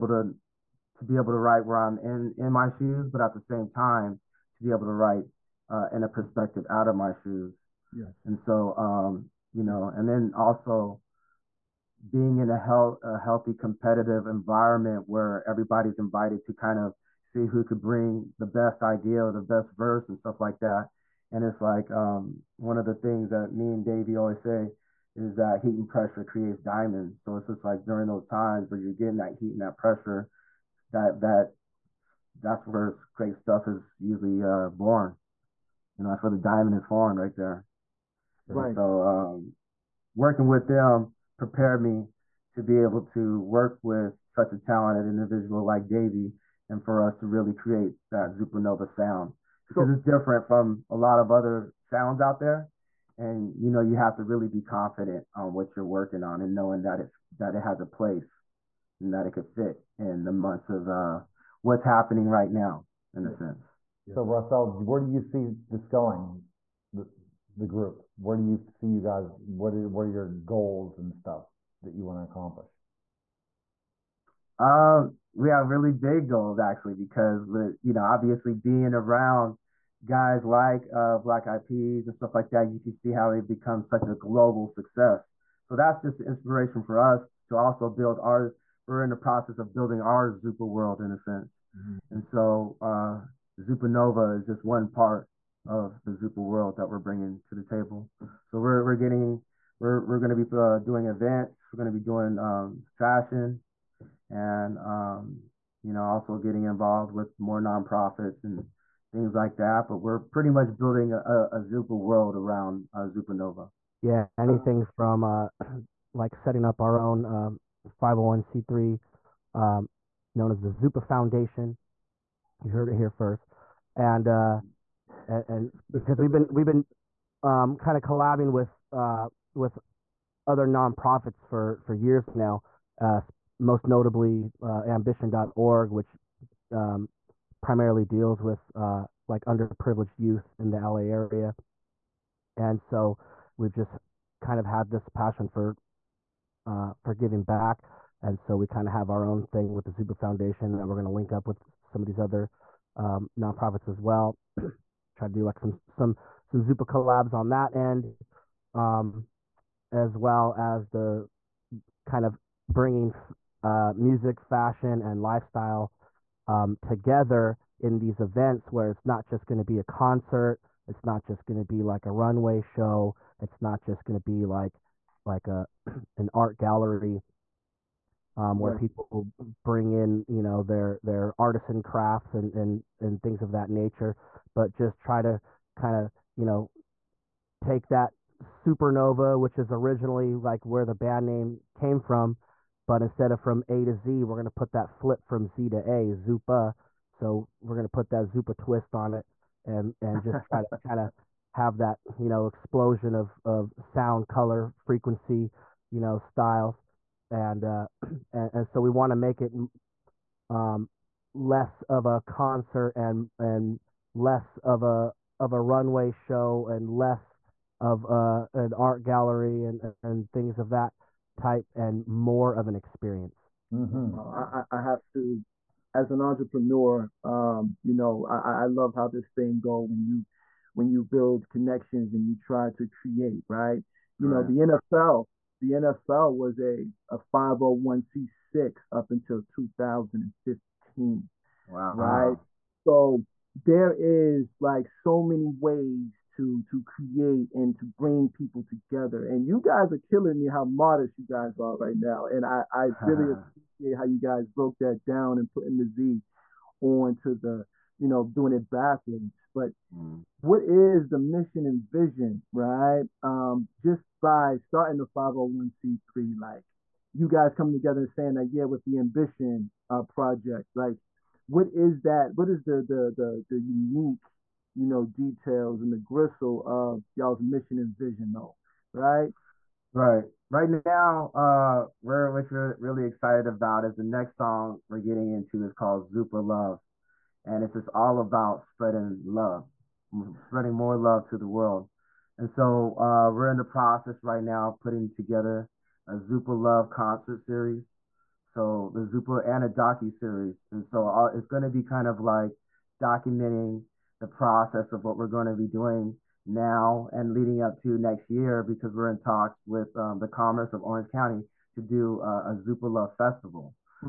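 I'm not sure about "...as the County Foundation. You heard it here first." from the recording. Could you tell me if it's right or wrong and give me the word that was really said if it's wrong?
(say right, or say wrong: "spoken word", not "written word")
wrong: "Zupa", not "County".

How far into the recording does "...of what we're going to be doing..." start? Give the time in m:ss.
5:04.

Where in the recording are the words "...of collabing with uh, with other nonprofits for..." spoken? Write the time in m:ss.
2:07.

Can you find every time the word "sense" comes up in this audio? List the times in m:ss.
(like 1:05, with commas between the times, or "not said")
1:03, 1:31.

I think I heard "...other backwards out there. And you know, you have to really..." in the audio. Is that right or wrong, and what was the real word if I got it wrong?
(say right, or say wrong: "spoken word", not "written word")
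wrong: "sounds", not "backwards".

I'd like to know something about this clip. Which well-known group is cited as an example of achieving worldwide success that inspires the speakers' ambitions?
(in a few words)
Black Eyed Peas.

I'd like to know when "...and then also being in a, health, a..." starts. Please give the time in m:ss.
0:09.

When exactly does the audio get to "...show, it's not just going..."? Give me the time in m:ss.
2:52.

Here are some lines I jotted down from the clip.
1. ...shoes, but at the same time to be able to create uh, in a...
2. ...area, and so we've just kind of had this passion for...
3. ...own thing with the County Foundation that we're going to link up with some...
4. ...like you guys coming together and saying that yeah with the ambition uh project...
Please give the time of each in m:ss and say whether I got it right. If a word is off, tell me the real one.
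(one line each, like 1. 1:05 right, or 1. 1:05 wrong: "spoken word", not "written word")
1. 0:02 wrong: "write", not "create"
2. 2:21 right
3. 2:29 wrong: "Zupa", not "County"
4. 4:26 right.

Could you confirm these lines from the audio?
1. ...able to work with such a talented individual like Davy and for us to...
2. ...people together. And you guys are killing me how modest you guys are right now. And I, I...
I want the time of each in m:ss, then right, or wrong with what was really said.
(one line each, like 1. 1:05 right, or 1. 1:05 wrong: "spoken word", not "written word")
1. 0:42 right
2. 4:08 right.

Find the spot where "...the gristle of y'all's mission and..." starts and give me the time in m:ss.
4:35.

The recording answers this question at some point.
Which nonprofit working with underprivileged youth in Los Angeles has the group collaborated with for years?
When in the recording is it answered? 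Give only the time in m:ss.
2:14.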